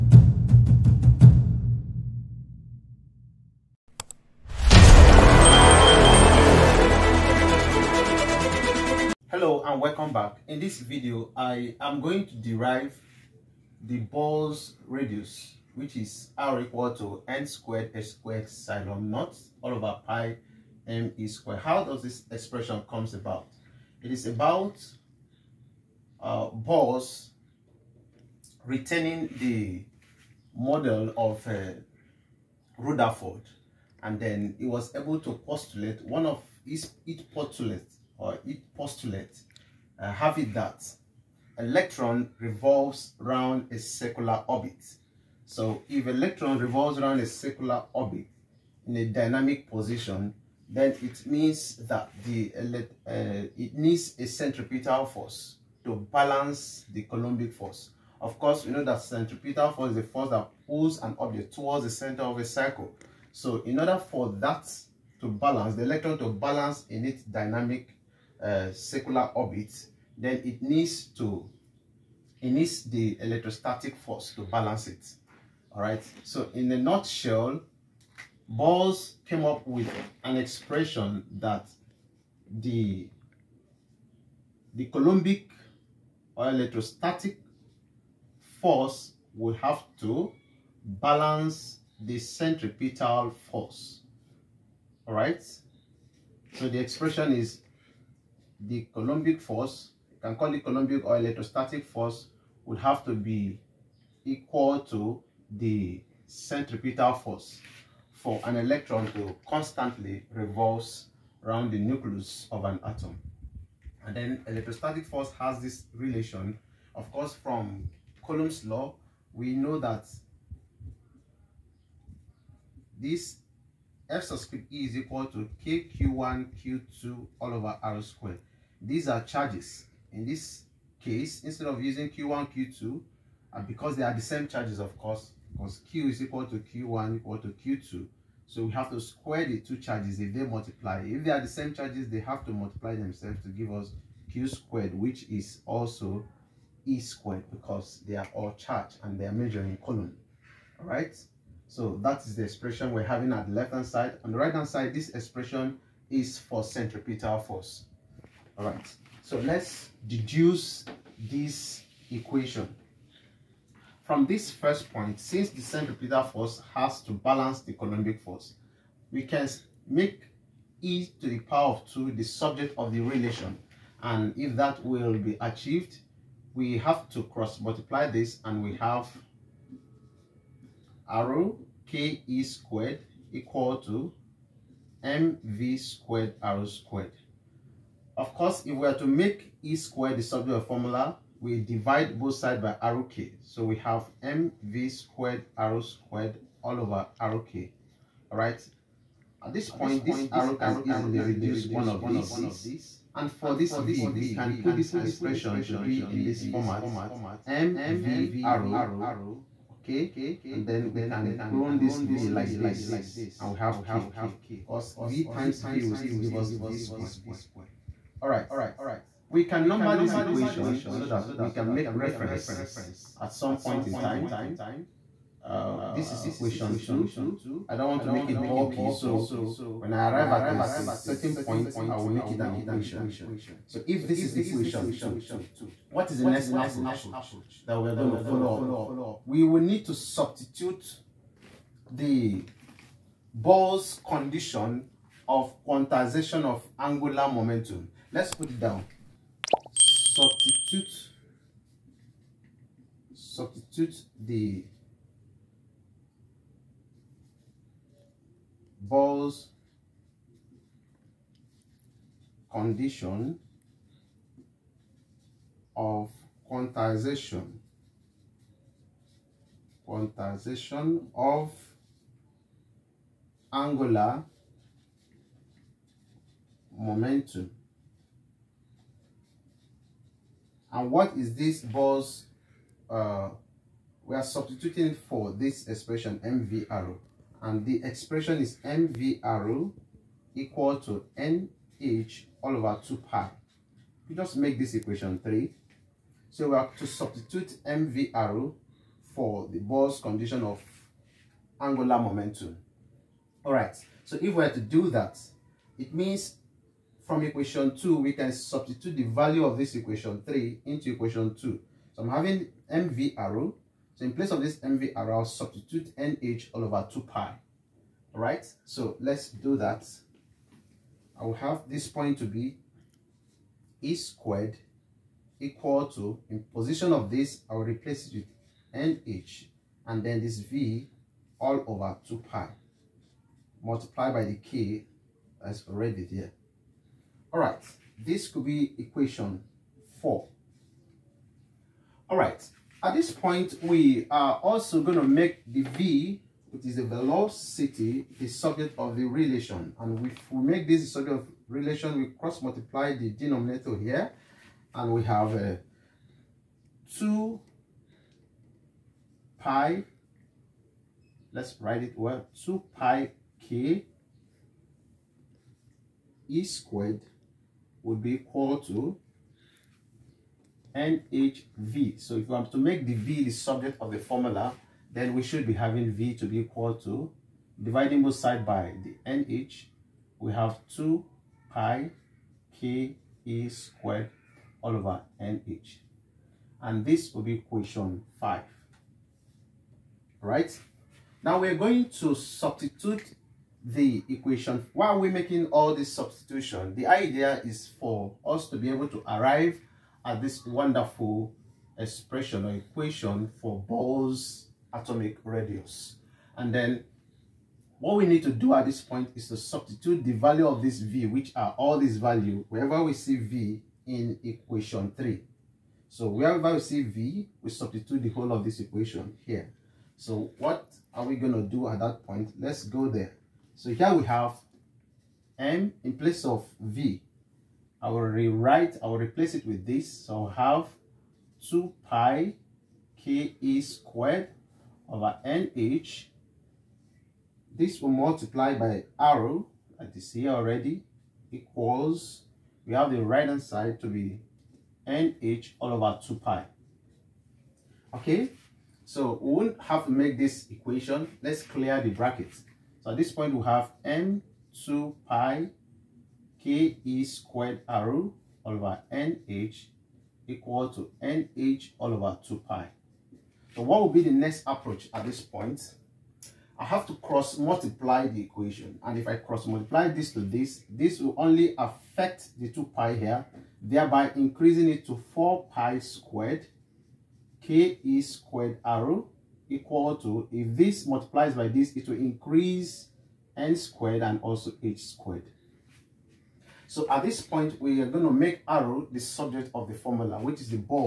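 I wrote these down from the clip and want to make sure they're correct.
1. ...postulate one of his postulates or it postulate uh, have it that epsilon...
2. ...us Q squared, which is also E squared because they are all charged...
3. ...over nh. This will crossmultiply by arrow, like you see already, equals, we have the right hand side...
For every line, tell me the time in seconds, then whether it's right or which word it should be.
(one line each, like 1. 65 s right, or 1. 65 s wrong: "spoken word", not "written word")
1. 35 s wrong: "electron", not "epsilon"
2. 143 s right
3. 434 s wrong: "multiply", not "crossmultiply".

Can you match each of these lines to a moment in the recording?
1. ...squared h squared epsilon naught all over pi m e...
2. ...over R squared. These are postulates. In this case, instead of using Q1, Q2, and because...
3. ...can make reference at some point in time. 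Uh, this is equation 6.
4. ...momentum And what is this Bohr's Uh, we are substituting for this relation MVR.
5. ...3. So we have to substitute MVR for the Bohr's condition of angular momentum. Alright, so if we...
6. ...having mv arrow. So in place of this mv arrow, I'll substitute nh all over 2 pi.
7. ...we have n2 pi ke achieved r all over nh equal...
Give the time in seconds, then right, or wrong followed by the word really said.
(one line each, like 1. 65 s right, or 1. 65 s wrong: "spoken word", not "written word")
1. 17 s right
2. 127 s wrong: "charges", not "postulates"
3. 221 s wrong: "2", not "6"
4. 276 s wrong: "expression", not "relation"
5. 295 s right
6. 312 s right
7. 453 s wrong: "squared", not "achieved".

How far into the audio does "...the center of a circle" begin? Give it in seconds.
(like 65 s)
61 s.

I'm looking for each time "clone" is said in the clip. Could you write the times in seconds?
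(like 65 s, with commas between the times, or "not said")
211 s.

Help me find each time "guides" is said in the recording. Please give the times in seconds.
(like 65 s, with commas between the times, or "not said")
not said.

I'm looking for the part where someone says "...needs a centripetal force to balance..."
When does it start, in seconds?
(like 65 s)
53 s.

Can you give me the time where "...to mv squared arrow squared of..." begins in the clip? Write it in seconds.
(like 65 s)
183 s.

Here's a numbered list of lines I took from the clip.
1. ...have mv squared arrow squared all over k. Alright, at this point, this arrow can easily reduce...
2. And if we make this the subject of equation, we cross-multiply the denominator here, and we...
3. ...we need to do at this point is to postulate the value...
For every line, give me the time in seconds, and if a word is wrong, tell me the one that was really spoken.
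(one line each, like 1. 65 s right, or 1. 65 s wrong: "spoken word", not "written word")
1. 193 s right
2. 349 s wrong: "relation", not "equation"
3. 407 s wrong: "substitute", not "postulate".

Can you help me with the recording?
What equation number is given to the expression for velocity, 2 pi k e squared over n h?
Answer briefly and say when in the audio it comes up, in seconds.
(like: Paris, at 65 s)
5, at 387 s.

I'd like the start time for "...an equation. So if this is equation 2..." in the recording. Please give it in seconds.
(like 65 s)
232 s.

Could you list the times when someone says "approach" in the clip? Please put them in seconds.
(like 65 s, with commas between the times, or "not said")
236 s, 464 s.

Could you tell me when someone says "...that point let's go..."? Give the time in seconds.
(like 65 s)
421 s.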